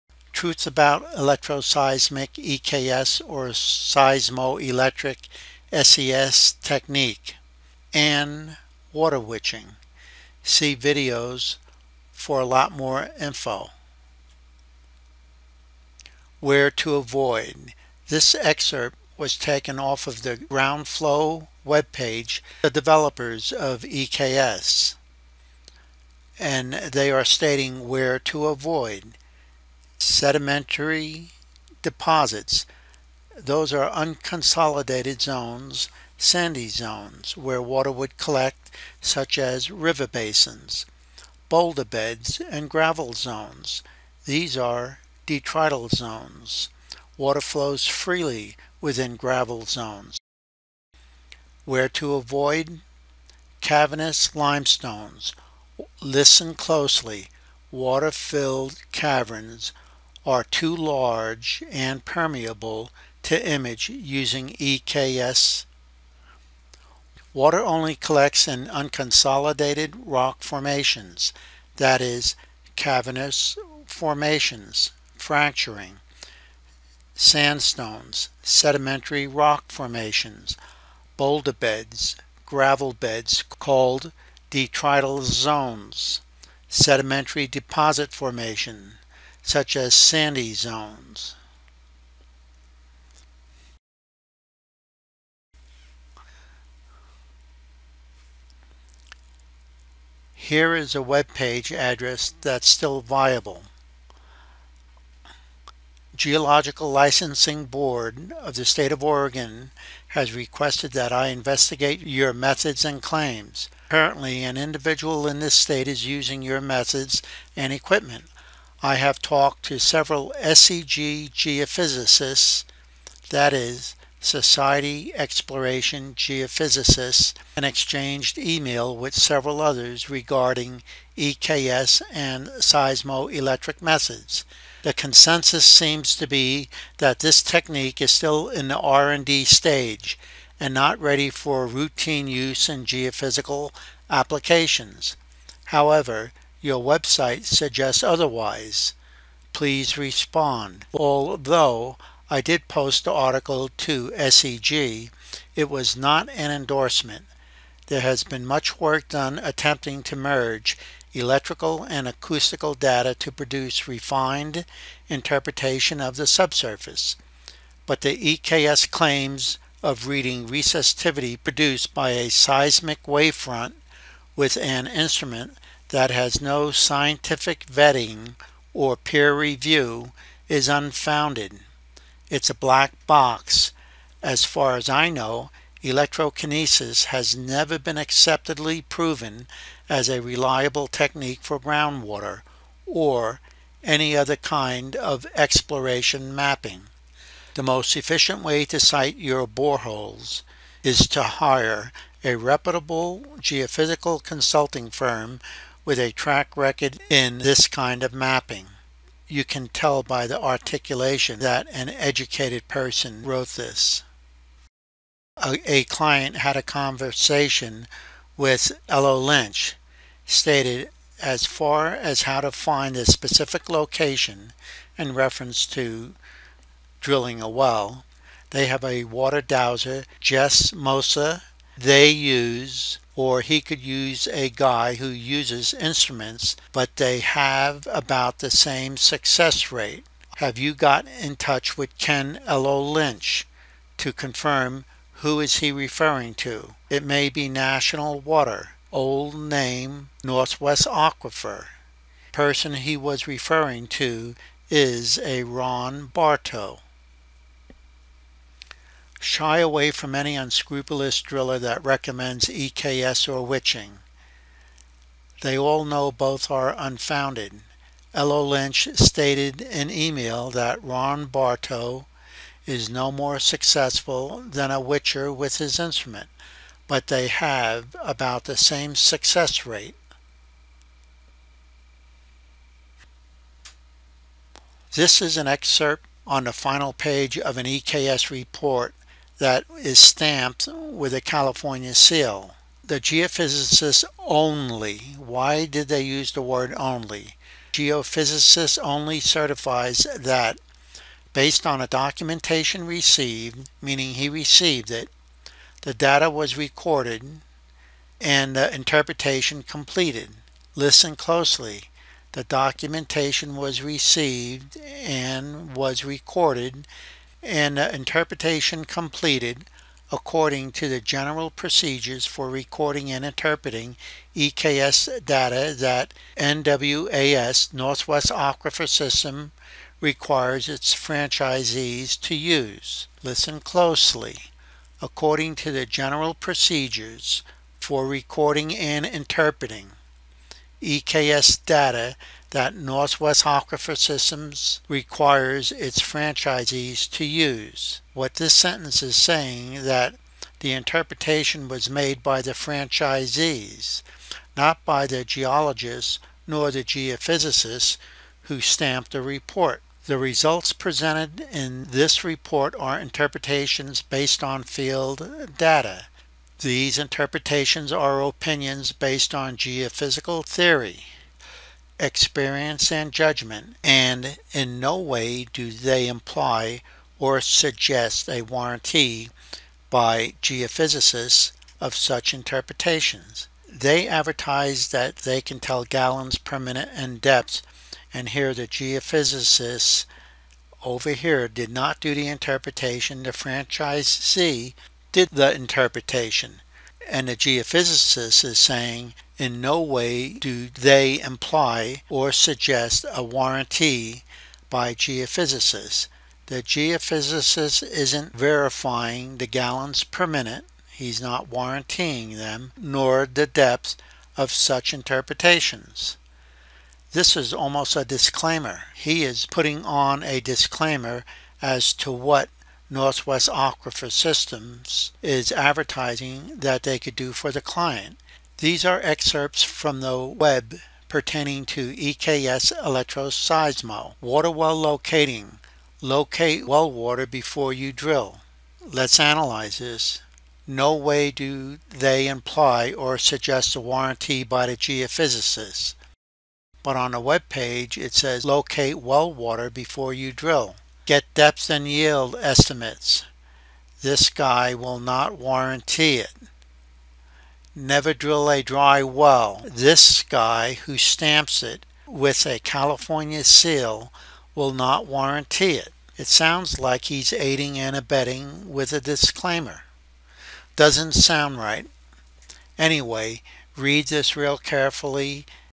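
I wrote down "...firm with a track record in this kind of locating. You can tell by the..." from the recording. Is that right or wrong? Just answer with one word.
wrong.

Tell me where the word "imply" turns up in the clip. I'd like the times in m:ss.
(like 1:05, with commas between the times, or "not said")
6:16, 6:41, 7:22.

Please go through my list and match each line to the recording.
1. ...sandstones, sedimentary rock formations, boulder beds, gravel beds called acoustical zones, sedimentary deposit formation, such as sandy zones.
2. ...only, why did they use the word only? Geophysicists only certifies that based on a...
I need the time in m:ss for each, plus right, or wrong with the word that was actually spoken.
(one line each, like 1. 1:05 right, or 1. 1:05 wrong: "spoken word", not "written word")
1. 1:17 wrong: "detrital", not "acoustical"
2. 4:54 right.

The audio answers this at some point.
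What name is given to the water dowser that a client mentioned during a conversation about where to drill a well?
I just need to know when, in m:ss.
3:50.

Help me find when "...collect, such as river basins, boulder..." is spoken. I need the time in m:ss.
0:38.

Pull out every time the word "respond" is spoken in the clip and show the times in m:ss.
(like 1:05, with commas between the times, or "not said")
2:29.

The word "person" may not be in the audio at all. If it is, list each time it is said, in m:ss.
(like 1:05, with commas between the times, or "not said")
3:32, 4:12.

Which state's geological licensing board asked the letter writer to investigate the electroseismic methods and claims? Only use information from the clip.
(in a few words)
Oregon.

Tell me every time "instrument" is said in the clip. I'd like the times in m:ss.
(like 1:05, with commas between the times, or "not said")
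2:54, 3:55, 4:35.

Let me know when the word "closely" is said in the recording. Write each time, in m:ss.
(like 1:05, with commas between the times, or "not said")
0:56, 5:11, 5:33.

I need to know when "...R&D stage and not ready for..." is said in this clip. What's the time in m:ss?
2:18.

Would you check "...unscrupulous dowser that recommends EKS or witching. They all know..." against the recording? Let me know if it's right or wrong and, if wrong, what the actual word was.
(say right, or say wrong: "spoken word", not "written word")
wrong: "driller", not "dowser".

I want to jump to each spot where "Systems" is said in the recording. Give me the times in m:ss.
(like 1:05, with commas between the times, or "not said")
5:28, 5:43, 7:04.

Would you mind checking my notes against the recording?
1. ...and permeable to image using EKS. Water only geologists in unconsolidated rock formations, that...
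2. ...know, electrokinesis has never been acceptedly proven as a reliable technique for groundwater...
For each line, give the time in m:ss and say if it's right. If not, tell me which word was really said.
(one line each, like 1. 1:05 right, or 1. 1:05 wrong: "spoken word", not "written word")
1. 1:01 wrong: "collects", not "geologists"
2. 3:05 right.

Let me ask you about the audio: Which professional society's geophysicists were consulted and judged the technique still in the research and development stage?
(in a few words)
Society Exploration Geophysicists.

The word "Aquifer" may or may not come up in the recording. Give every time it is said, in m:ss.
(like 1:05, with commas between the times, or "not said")
4:10, 5:28, 5:43, 7:03.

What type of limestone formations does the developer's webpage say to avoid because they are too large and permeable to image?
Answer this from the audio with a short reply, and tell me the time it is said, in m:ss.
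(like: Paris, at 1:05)
Cavernous limestones, at 0:53.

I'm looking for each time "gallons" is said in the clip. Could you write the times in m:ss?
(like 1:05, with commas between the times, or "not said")
6:25, 6:49.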